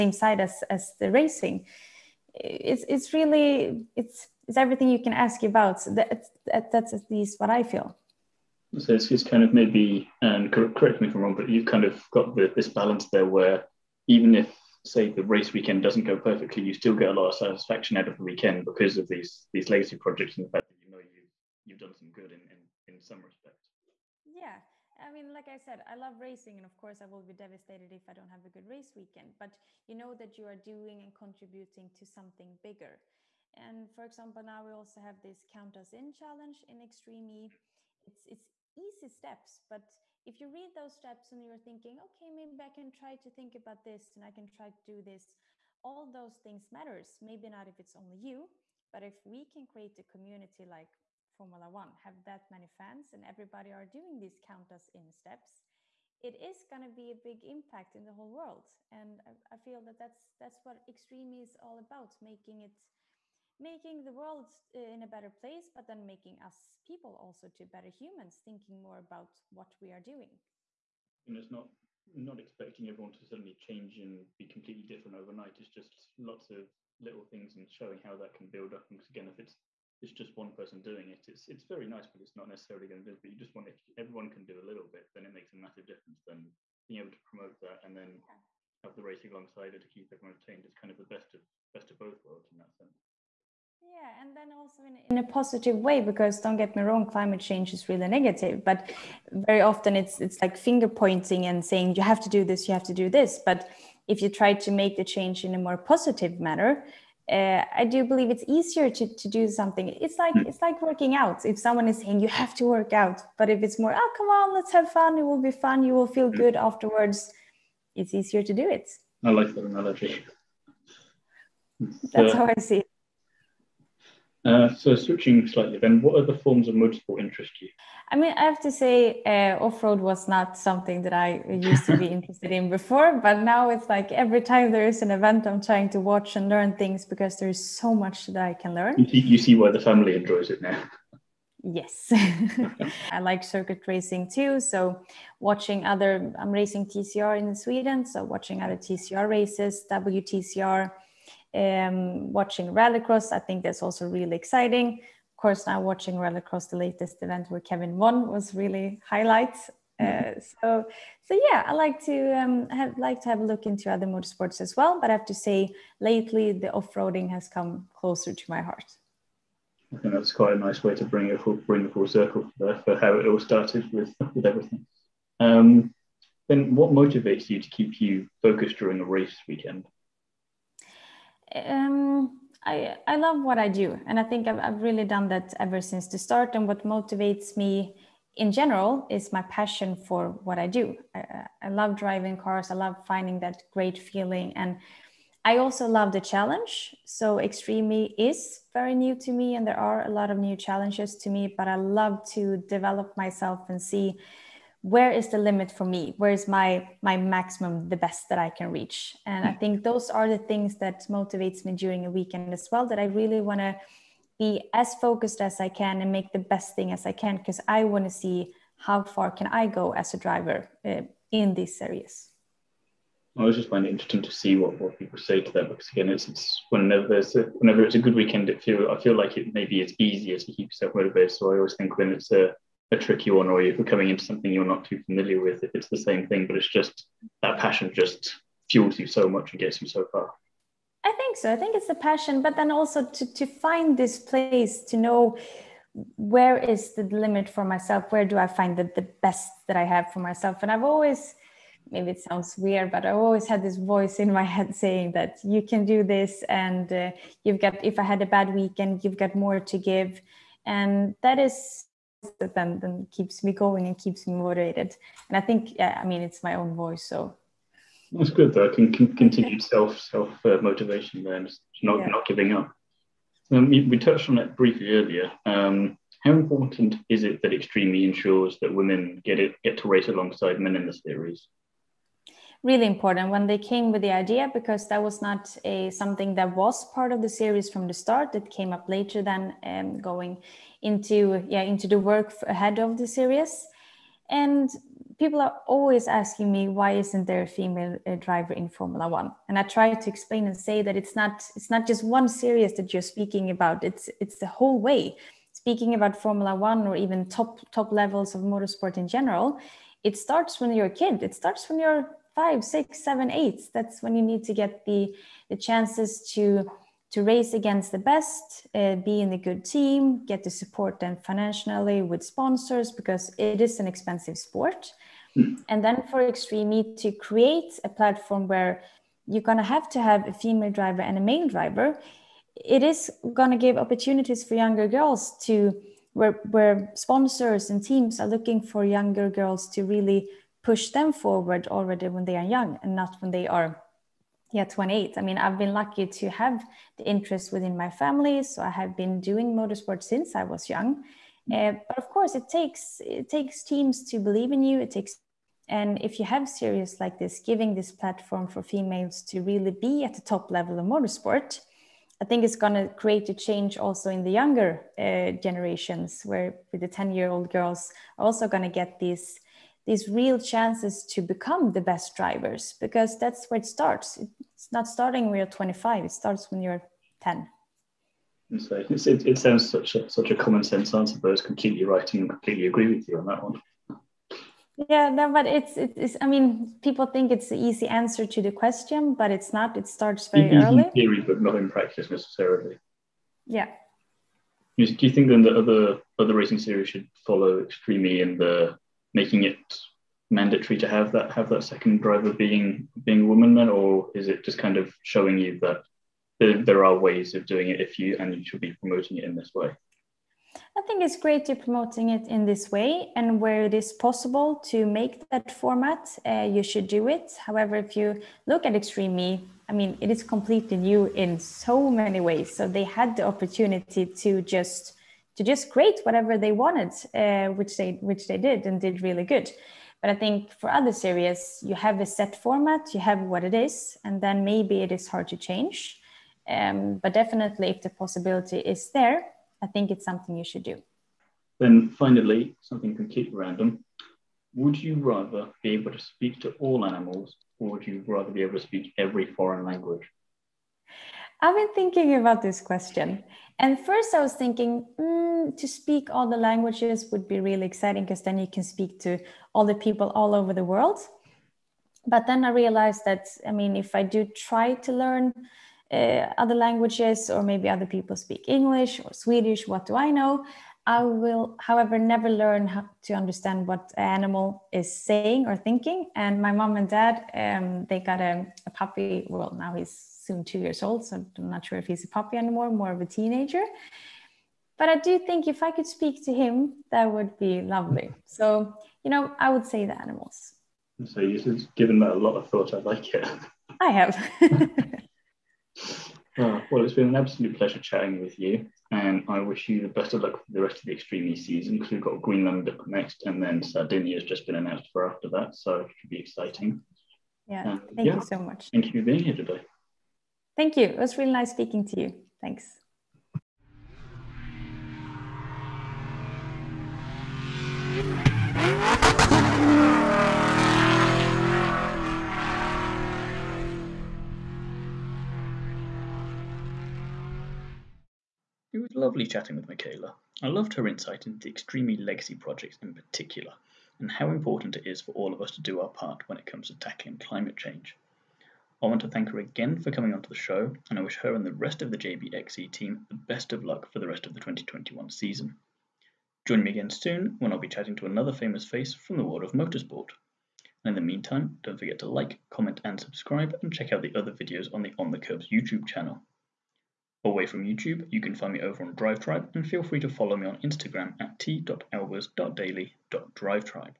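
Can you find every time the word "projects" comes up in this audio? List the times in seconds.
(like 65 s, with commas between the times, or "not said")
20 s, 532 s.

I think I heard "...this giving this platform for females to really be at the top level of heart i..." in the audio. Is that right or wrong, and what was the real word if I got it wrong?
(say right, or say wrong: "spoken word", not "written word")
wrong: "motorsport", not "heart".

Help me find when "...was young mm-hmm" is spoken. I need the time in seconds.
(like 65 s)
350 s.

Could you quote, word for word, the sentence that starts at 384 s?
Yeah, no, but it's, it's, I mean, people think it's the easy answer to the question, but it's not.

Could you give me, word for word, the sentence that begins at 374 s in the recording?
It's not starting when you're 25, it starts when you're 10.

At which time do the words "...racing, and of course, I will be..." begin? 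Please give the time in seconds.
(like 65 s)
26 s.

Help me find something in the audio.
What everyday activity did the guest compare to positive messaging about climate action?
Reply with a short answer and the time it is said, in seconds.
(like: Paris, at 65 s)
Working out, at 110 s.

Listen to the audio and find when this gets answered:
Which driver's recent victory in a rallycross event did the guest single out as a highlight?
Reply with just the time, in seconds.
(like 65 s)
157 s.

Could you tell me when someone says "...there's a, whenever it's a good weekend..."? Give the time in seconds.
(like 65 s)
227 s.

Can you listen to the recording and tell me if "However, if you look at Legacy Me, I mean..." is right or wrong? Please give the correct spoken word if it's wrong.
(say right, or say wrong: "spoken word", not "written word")
wrong: "Extreme", not "Legacy".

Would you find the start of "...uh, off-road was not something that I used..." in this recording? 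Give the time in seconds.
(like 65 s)
129 s.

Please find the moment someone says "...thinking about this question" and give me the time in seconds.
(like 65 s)
451 s.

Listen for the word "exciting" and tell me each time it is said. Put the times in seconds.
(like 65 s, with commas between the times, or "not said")
154 s, 457 s, 506 s.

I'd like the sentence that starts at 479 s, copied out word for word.
Well, now he's soon two years old, so I'm not sure if he's a puppy anymore, more of a teenager.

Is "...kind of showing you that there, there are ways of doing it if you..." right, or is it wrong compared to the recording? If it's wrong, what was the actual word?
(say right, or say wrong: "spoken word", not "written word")
right.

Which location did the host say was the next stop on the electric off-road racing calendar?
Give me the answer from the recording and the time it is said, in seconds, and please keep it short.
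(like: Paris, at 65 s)
Greenland, at 502 s.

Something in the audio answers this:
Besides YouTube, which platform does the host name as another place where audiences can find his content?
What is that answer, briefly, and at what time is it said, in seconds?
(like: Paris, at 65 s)
DriveTribe, at 558 s.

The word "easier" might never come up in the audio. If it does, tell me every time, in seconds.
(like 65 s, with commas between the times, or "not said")
108 s, 118 s, 229 s.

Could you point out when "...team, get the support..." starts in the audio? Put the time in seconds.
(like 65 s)
319 s.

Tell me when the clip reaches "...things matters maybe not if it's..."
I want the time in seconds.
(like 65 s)
46 s.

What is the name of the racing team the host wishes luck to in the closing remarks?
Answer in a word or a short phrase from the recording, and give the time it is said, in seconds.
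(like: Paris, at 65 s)
JBXE, at 541 s.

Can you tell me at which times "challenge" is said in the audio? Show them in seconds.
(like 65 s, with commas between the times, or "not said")
36 s, 196 s, 200 s.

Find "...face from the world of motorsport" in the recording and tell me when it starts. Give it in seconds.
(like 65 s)
548 s.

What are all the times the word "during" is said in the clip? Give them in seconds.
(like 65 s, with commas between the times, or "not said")
178 s, 211 s.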